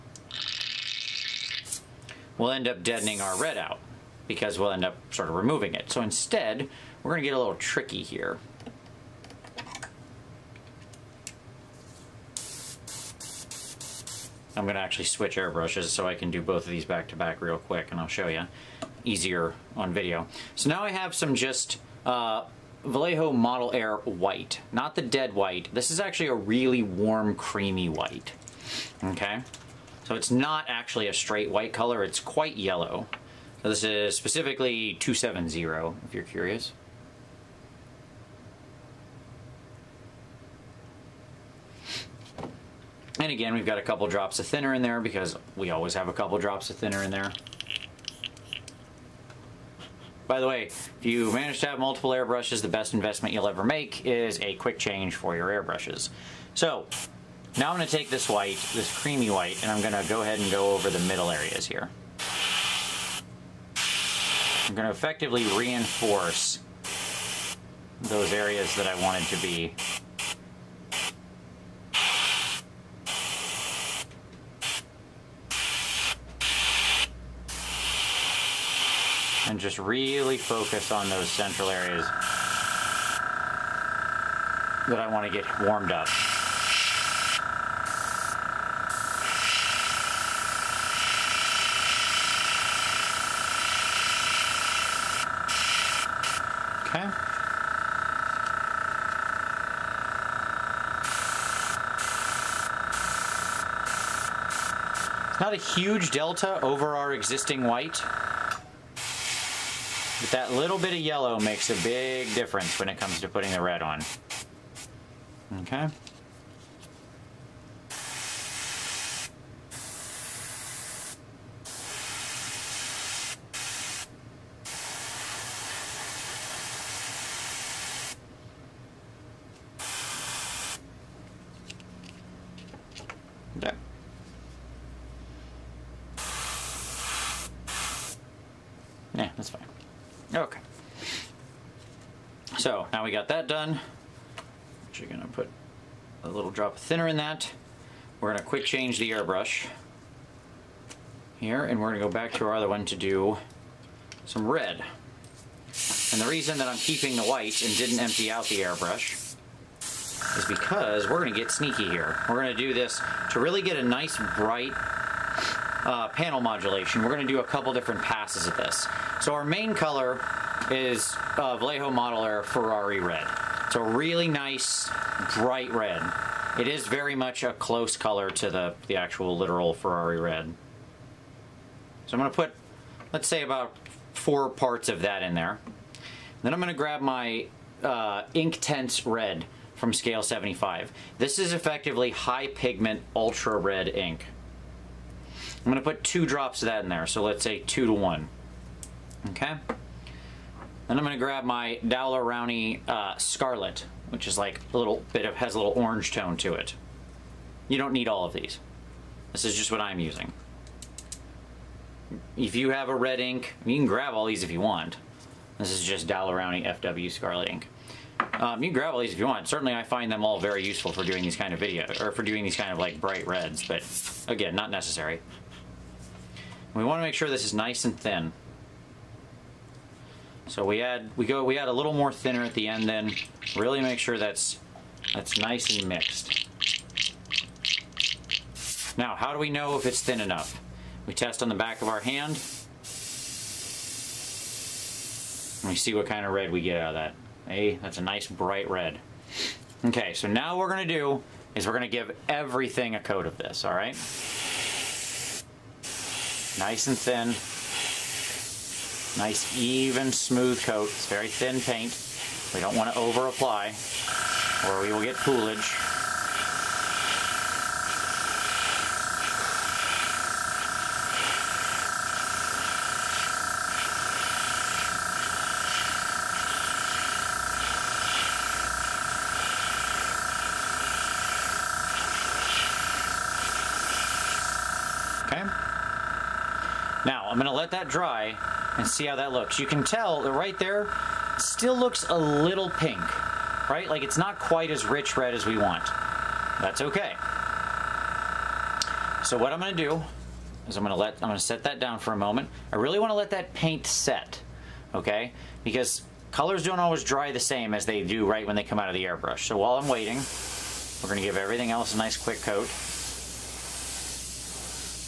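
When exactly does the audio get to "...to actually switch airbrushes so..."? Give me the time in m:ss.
0:14.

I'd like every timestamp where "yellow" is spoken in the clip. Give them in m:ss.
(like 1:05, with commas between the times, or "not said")
0:32, 1:50.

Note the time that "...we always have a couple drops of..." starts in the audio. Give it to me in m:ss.
0:45.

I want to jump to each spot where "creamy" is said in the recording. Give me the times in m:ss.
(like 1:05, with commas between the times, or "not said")
0:27, 0:59.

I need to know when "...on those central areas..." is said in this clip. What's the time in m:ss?
1:20.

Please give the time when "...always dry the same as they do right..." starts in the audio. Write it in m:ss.
5:06.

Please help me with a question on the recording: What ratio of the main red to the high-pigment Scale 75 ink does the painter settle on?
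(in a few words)
2 to 1.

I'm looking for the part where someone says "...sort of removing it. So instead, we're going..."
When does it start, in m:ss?
0:05.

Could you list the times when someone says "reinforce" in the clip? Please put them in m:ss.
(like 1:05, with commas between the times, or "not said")
1:05.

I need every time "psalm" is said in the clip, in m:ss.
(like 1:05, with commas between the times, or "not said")
not said.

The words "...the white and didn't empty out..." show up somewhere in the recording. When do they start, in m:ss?
2:37.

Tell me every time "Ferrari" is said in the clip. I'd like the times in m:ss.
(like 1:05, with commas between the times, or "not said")
2:52, 2:59.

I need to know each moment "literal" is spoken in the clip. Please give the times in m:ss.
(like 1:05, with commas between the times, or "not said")
2:59.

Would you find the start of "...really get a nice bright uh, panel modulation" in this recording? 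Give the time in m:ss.
2:43.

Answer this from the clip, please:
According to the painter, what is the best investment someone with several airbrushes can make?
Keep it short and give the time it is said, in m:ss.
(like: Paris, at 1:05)
a quick change, at 0:54.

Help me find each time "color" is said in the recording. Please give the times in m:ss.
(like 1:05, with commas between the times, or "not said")
0:31, 2:49, 2:57, 5:06.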